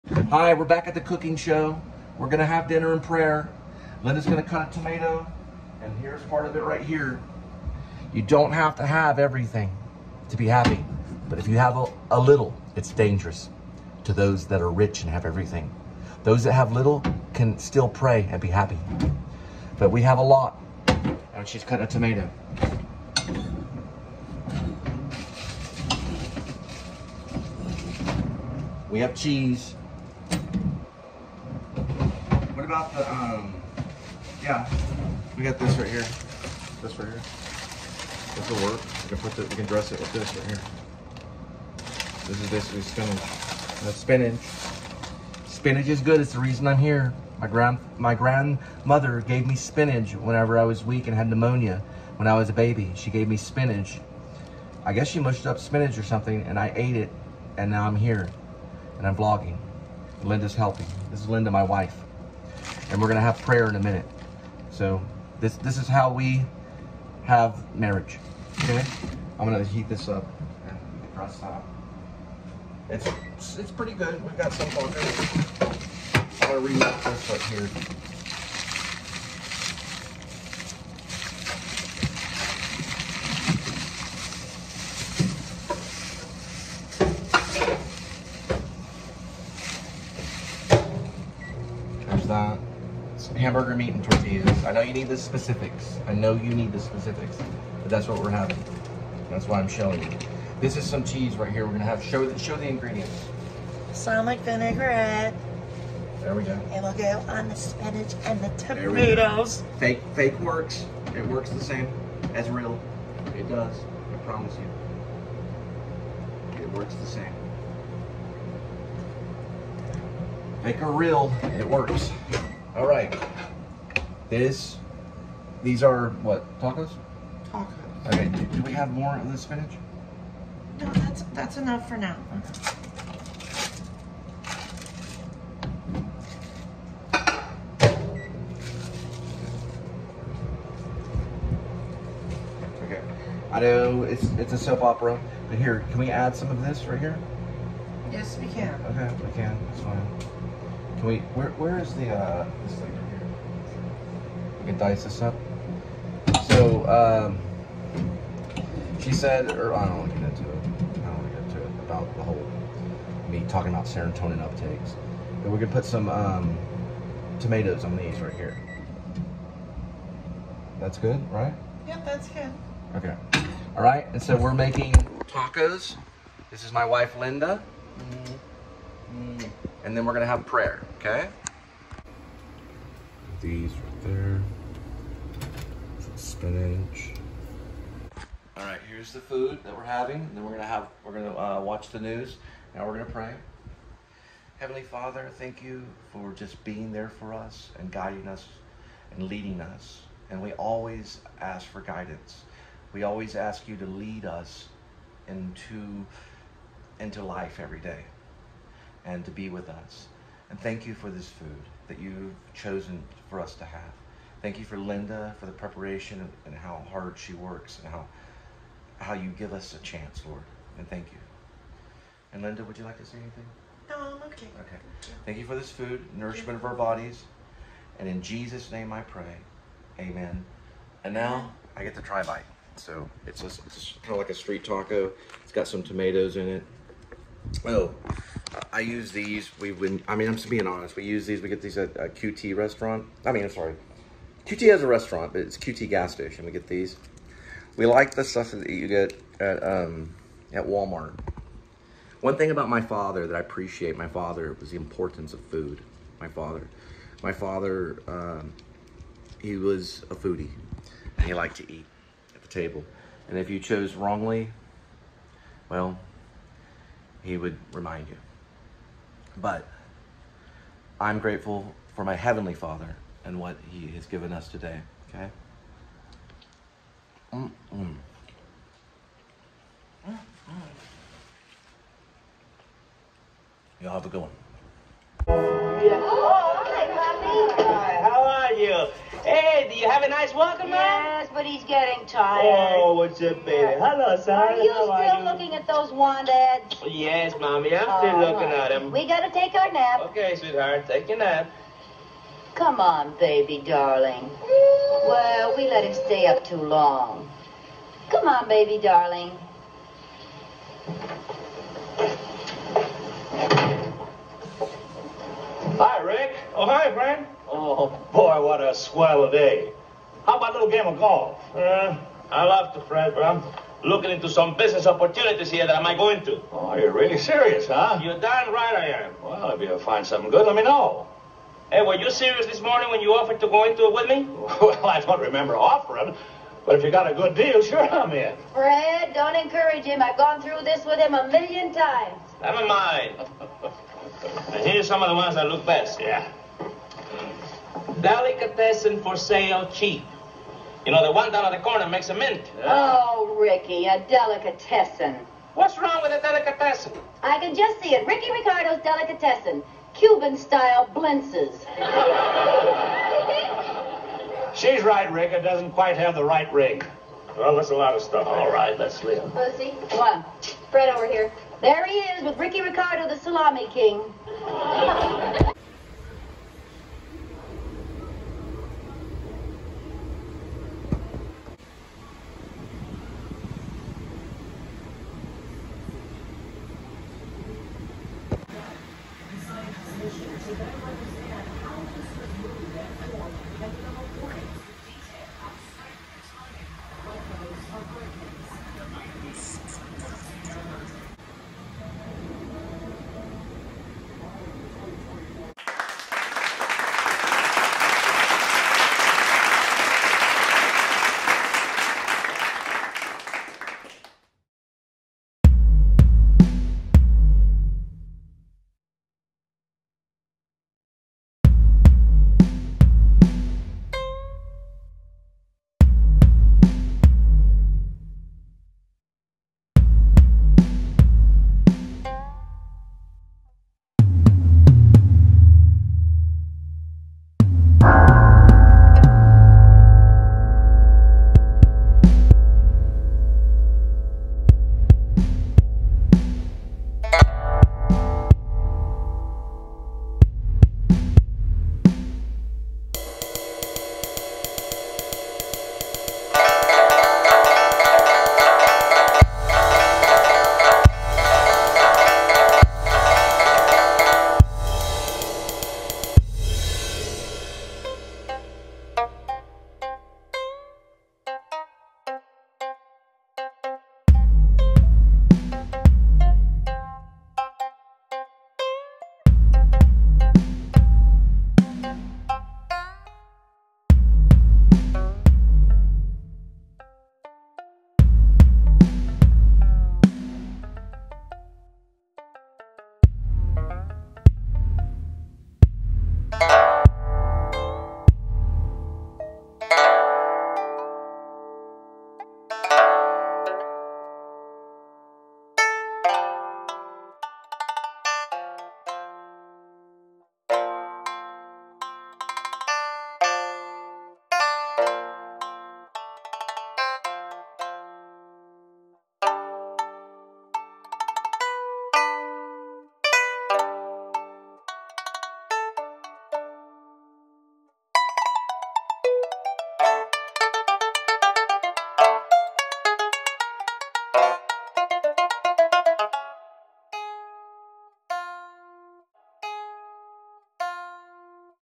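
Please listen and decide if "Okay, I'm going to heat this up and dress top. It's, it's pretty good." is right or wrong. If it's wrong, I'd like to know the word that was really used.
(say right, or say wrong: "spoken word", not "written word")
wrong: "press", not "dress".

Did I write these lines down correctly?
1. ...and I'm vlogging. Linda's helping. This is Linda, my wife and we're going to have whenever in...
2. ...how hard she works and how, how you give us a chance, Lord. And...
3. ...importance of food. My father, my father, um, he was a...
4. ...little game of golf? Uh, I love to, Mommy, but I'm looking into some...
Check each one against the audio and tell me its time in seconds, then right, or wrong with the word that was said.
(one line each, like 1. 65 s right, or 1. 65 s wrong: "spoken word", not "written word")
1. 58 s wrong: "prayer", not "whenever"
2. 216 s right
3. 254 s right
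4. 320 s wrong: "Fred", not "Mommy".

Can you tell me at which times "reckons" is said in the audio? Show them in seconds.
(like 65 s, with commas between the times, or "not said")
not said.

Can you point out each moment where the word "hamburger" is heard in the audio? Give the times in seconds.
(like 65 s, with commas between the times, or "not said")
93 s.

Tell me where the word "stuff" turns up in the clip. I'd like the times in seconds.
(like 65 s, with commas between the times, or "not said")
248 s, 368 s.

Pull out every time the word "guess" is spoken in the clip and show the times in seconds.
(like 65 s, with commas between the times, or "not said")
54 s.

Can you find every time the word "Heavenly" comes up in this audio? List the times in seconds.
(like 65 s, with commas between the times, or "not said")
194 s, 272 s.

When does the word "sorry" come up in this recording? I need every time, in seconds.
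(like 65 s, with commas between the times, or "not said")
243 s.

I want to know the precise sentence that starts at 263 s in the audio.
And if you chose wrongly, well, he would remind you.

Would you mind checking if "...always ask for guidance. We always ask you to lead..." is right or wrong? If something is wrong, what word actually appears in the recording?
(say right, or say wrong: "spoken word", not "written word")
right.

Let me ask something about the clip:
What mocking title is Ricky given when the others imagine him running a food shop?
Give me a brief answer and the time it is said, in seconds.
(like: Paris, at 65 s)
The salami king, at 373 s.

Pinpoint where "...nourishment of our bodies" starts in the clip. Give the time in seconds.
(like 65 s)
226 s.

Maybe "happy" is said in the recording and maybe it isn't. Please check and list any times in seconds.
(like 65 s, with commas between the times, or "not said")
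10 s, 18 s.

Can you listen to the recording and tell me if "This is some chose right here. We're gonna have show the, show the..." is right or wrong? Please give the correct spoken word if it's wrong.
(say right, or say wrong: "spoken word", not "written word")
wrong: "cheese", not "chose".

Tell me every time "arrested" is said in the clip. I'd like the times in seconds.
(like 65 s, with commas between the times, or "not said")
not said.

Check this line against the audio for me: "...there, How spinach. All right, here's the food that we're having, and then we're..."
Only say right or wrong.
wrong.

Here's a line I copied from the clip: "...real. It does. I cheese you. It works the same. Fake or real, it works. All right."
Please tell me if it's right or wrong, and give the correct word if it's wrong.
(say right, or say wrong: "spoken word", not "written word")
wrong: "promise", not "cheese".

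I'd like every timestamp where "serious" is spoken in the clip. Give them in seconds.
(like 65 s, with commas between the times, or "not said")
327 s, 332 s.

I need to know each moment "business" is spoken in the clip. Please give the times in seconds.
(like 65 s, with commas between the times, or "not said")
324 s.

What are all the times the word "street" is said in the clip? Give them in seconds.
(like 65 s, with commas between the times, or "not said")
234 s.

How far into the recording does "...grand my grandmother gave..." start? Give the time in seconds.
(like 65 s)
47 s.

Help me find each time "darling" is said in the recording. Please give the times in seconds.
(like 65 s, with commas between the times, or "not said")
303 s, 308 s.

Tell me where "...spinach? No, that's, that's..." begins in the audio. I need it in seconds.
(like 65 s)
129 s.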